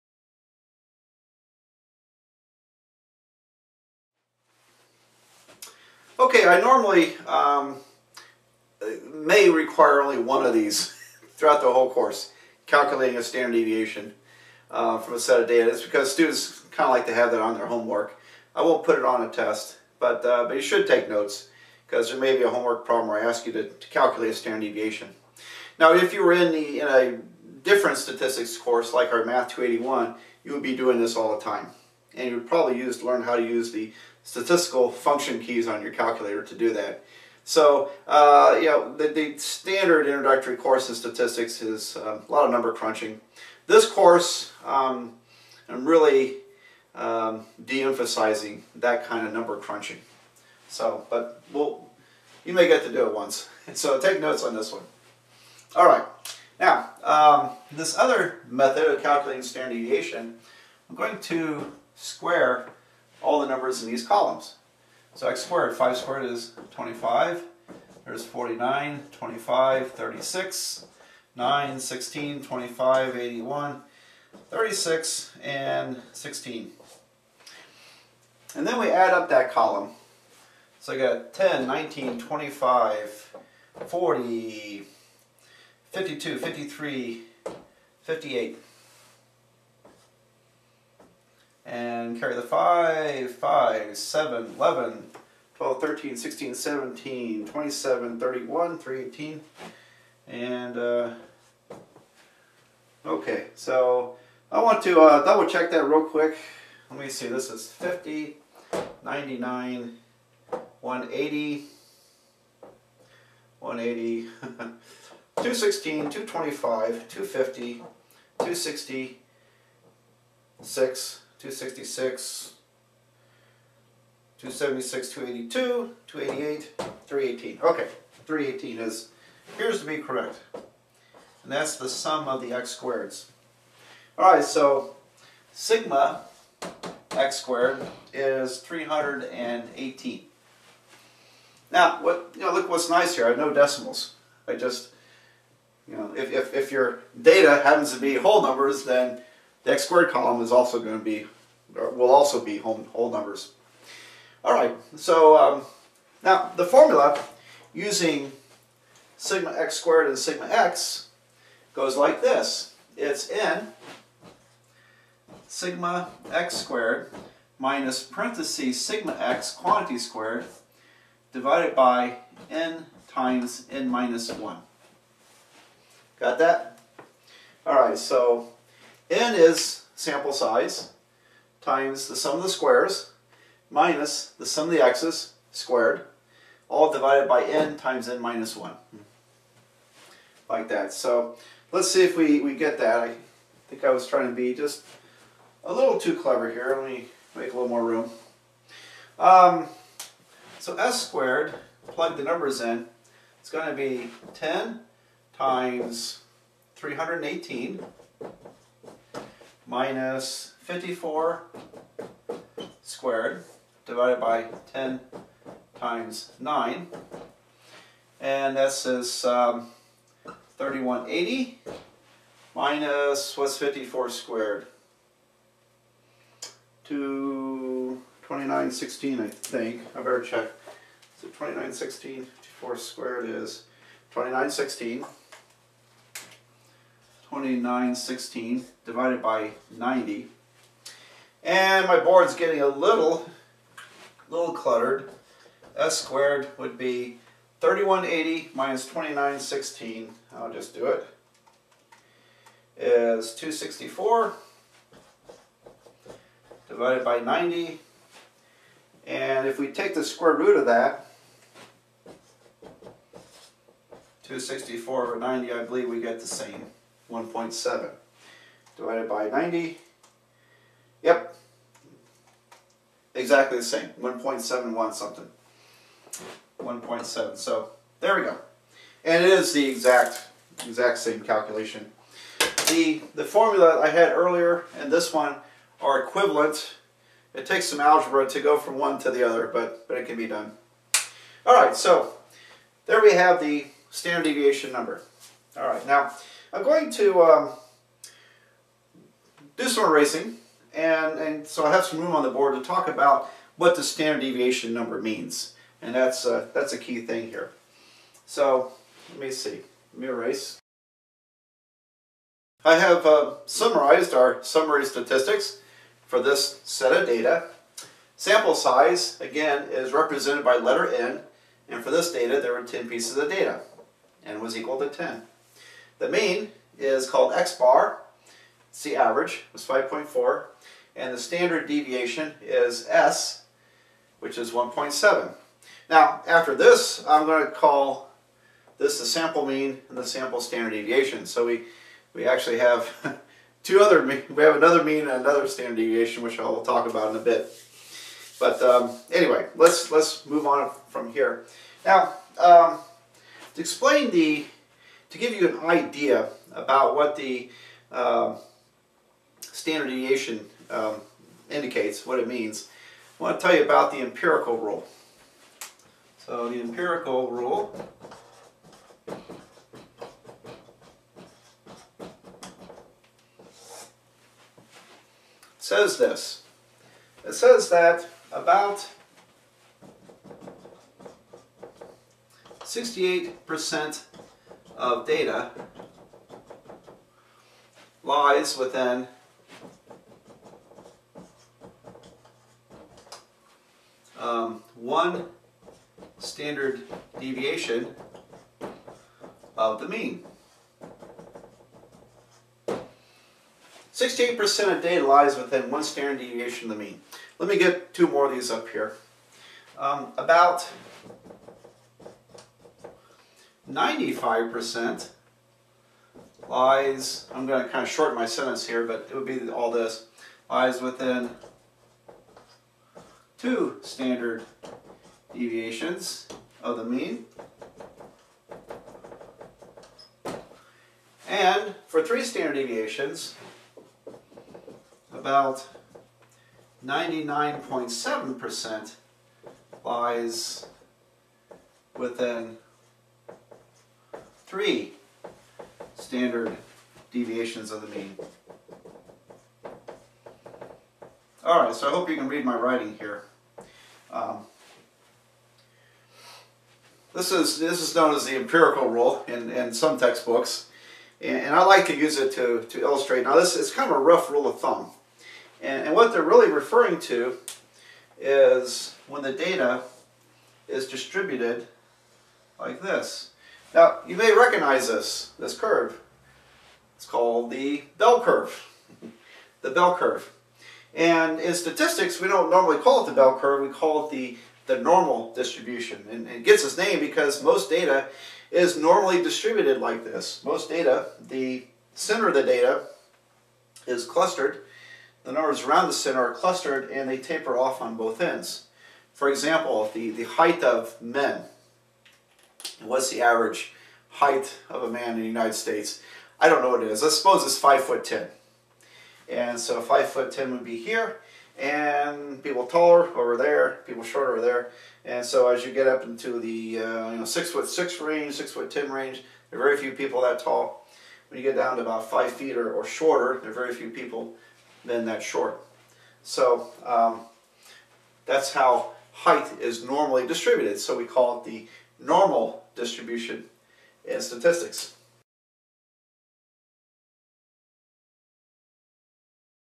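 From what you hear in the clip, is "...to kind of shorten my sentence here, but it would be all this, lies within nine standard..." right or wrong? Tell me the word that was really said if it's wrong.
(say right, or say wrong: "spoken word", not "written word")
wrong: "two", not "nine".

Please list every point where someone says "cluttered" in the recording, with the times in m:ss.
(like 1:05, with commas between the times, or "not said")
4:04.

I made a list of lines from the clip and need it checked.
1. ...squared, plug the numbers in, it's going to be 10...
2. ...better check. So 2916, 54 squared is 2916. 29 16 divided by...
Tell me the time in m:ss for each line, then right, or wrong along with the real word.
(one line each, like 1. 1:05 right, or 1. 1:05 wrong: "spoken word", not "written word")
1. 3:21 right
2. 3:49 right.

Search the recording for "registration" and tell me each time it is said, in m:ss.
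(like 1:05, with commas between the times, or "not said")
not said.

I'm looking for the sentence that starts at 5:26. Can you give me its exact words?
The mean is called x-bar, it's the average, was 5.4, and the standard deviation is s, which is 1.7.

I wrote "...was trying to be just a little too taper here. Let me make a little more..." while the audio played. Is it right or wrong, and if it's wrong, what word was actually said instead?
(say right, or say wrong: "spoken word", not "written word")
wrong: "clever", not "taper".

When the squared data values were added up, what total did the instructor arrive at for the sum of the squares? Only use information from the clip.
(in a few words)
318.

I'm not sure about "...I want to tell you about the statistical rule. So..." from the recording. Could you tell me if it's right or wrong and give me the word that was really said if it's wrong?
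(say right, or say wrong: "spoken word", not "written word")
wrong: "empirical", not "statistical".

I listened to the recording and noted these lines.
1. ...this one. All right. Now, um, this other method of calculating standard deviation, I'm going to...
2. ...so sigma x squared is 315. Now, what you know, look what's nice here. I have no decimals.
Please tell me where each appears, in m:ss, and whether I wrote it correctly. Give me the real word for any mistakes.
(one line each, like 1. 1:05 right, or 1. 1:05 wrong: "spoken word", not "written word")
1. 0:54 right
2. 2:14 wrong: "318", not "315".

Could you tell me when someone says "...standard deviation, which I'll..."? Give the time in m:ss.
5:45.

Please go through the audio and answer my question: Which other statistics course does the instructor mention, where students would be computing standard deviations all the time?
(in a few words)
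Math 281.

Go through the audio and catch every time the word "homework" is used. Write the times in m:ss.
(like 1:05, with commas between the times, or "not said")
0:17, 0:22.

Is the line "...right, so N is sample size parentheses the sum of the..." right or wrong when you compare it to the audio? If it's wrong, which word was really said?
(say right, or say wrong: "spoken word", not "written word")
wrong: "times", not "parentheses".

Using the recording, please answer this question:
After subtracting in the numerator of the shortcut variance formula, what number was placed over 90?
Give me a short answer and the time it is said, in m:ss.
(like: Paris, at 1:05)
264, at 4:12.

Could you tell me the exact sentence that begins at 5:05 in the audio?
And that's, uh, that's a key thing here.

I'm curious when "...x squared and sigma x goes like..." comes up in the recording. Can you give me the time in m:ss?
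2:39.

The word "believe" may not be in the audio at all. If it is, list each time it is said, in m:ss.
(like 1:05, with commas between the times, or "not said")
4:25.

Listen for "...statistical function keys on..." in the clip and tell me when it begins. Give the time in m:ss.
0:34.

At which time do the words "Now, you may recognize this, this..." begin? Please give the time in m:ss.
7:53.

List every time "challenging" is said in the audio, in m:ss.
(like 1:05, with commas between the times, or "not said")
not said.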